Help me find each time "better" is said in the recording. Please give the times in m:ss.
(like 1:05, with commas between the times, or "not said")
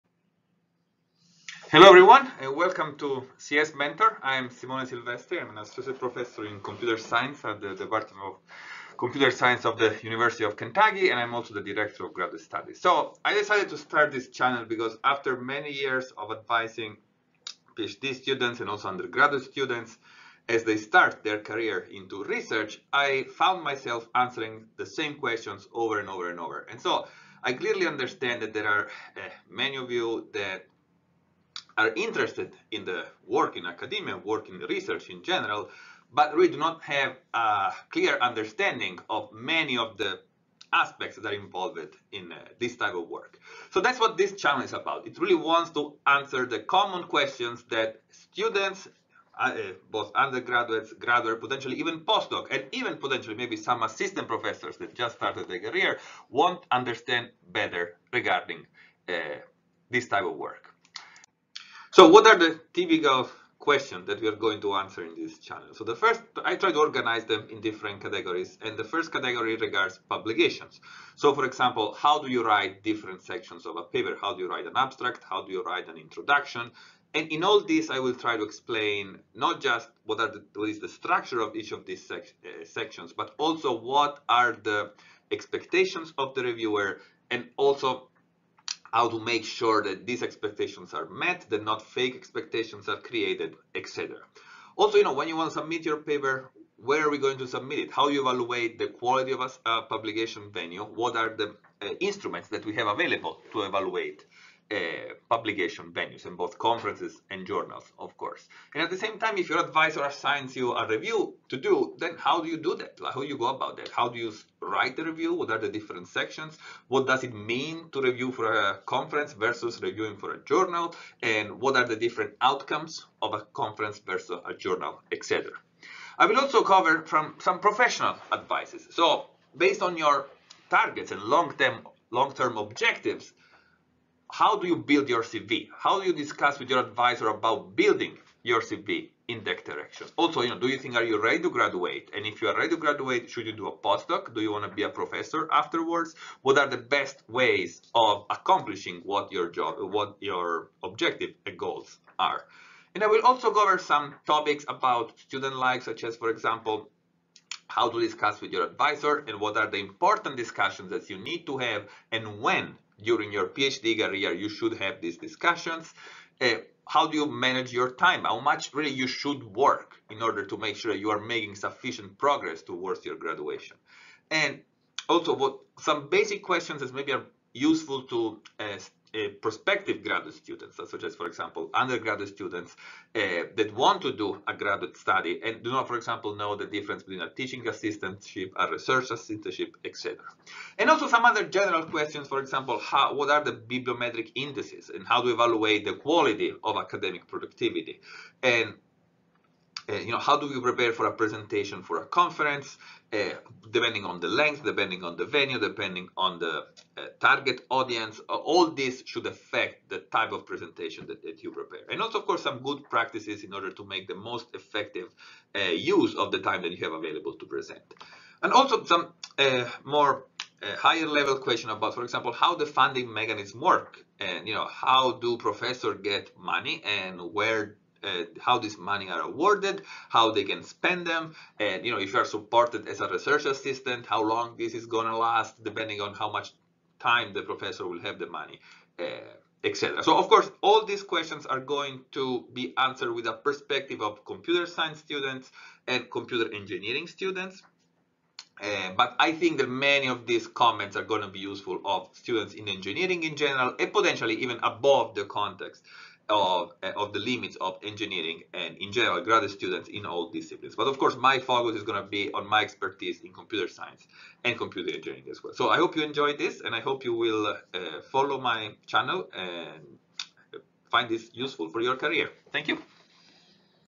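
0:57.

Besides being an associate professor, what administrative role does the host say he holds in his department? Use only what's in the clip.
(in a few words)
Director of graduate studies.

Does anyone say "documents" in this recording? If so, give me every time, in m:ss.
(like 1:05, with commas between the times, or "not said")
not said.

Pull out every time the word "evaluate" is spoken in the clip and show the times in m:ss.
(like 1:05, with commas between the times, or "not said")
1:38, 1:43, 3:15.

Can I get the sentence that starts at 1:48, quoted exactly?
And at the same time, if your advisor assigns you a review to do, then how do you do that?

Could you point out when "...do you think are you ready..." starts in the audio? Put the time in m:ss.
2:20.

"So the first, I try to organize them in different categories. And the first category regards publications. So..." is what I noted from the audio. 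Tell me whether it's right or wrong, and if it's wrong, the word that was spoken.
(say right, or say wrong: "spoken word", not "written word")
right.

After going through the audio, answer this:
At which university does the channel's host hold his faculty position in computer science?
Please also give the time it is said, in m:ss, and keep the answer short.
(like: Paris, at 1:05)
University of Kentucky, at 0:10.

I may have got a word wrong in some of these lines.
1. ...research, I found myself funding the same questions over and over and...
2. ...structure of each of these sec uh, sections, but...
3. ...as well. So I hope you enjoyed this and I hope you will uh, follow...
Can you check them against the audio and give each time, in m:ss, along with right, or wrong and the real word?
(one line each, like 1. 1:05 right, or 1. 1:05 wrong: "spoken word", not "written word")
1. 0:22 wrong: "answering", not "funding"
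2. 1:20 right
3. 4:25 right.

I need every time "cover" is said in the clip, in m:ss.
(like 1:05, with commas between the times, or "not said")
2:06, 2:33.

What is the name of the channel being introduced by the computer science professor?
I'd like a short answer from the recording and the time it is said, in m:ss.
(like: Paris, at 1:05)
CS Mentor, at 0:03.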